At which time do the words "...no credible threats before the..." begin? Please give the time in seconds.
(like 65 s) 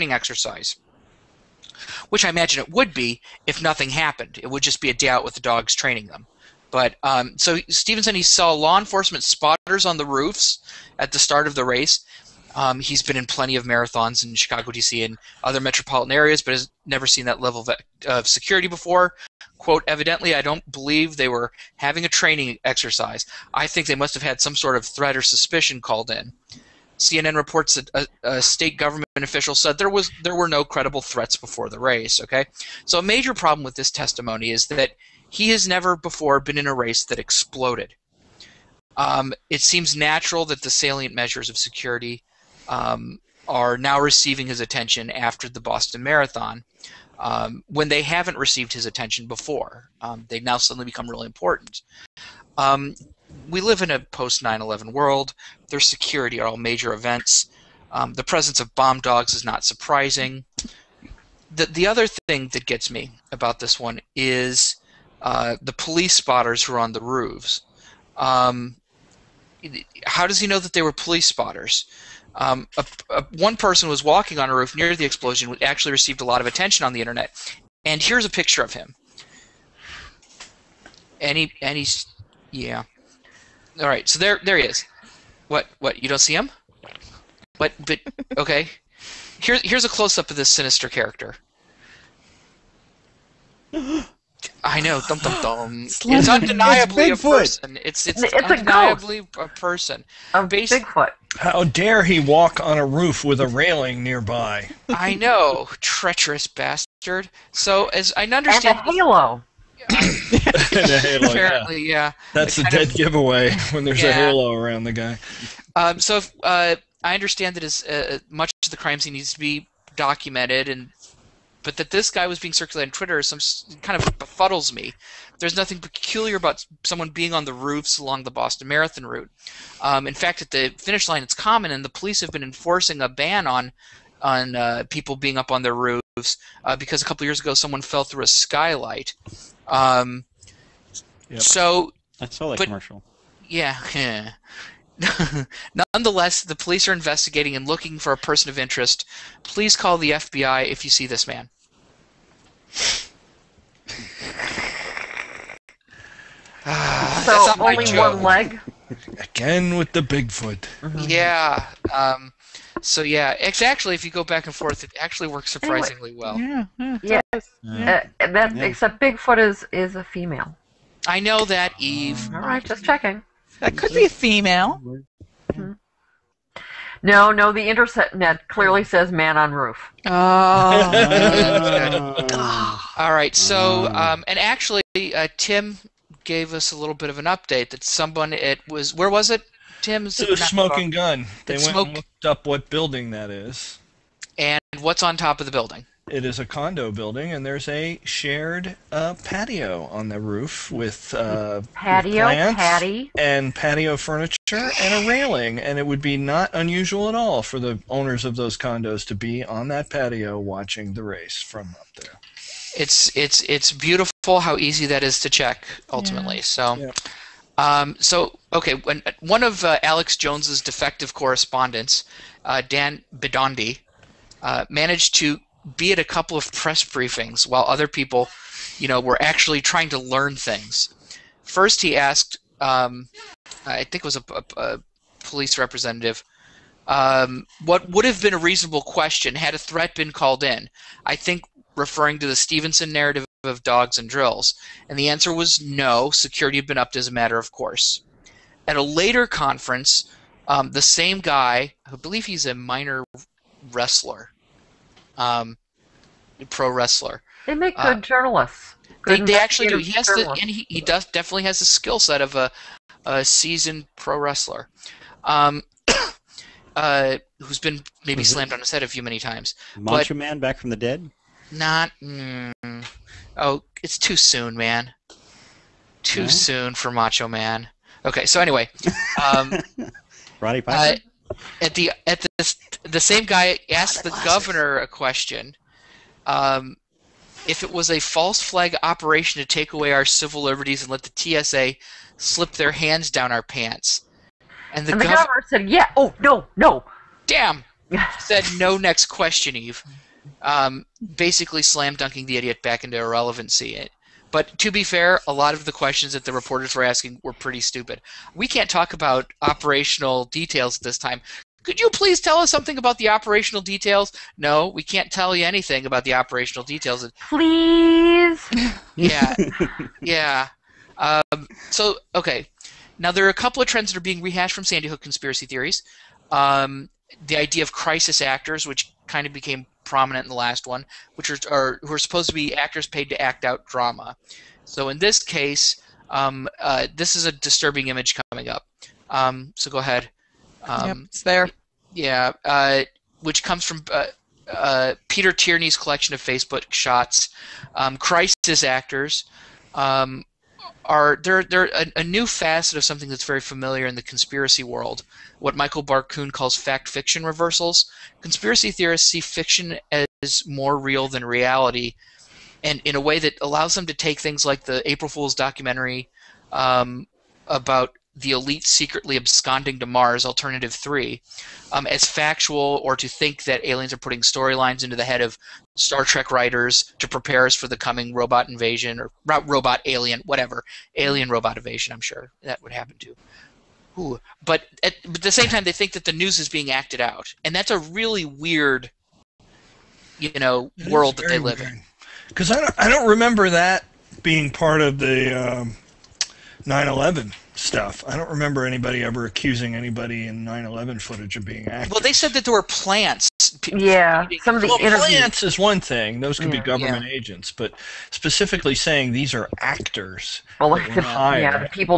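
30 s.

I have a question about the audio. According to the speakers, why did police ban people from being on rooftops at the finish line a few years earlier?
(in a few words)
someone fell through a skylight.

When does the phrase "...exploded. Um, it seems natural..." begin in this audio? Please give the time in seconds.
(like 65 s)
37 s.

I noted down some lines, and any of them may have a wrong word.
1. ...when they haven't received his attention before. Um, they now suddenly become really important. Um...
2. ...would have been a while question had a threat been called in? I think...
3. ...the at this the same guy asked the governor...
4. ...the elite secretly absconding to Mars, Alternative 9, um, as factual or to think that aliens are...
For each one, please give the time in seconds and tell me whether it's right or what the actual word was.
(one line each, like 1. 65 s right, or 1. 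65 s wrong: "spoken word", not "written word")
1. 47 s right
2. 237 s wrong: "reasonable", not "while"
3. 281 s right
4. 368 s wrong: "3", not "9".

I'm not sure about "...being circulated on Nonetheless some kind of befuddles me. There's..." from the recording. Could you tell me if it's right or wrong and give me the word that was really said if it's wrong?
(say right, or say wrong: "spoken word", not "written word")
wrong: "Twitter", not "Nonetheless".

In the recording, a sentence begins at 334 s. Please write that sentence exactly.
So in this case, um, uh, this is a disturbing image coming up.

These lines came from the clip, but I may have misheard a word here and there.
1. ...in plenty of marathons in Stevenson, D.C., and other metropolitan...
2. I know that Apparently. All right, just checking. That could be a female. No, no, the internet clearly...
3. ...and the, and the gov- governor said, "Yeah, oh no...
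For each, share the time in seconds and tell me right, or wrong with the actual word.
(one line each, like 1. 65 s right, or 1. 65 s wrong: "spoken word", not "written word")
1. 13 s wrong: "Chicago", not "Stevenson"
2. 171 s wrong: "Eve", not "Apparently"
3. 294 s right.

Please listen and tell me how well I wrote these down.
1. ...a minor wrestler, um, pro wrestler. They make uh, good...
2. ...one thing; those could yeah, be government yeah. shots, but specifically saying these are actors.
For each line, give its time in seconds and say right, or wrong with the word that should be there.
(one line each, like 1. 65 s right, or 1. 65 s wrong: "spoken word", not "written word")
1. 252 s right
2. 405 s wrong: "agents", not "shots".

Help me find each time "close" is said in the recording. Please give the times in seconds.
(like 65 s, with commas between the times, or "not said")
89 s.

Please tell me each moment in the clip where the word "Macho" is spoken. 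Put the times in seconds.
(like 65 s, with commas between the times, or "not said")
269 s, 276 s.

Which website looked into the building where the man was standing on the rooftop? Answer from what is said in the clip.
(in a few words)
Smoking Gun.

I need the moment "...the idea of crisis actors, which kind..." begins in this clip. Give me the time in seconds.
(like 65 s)
327 s.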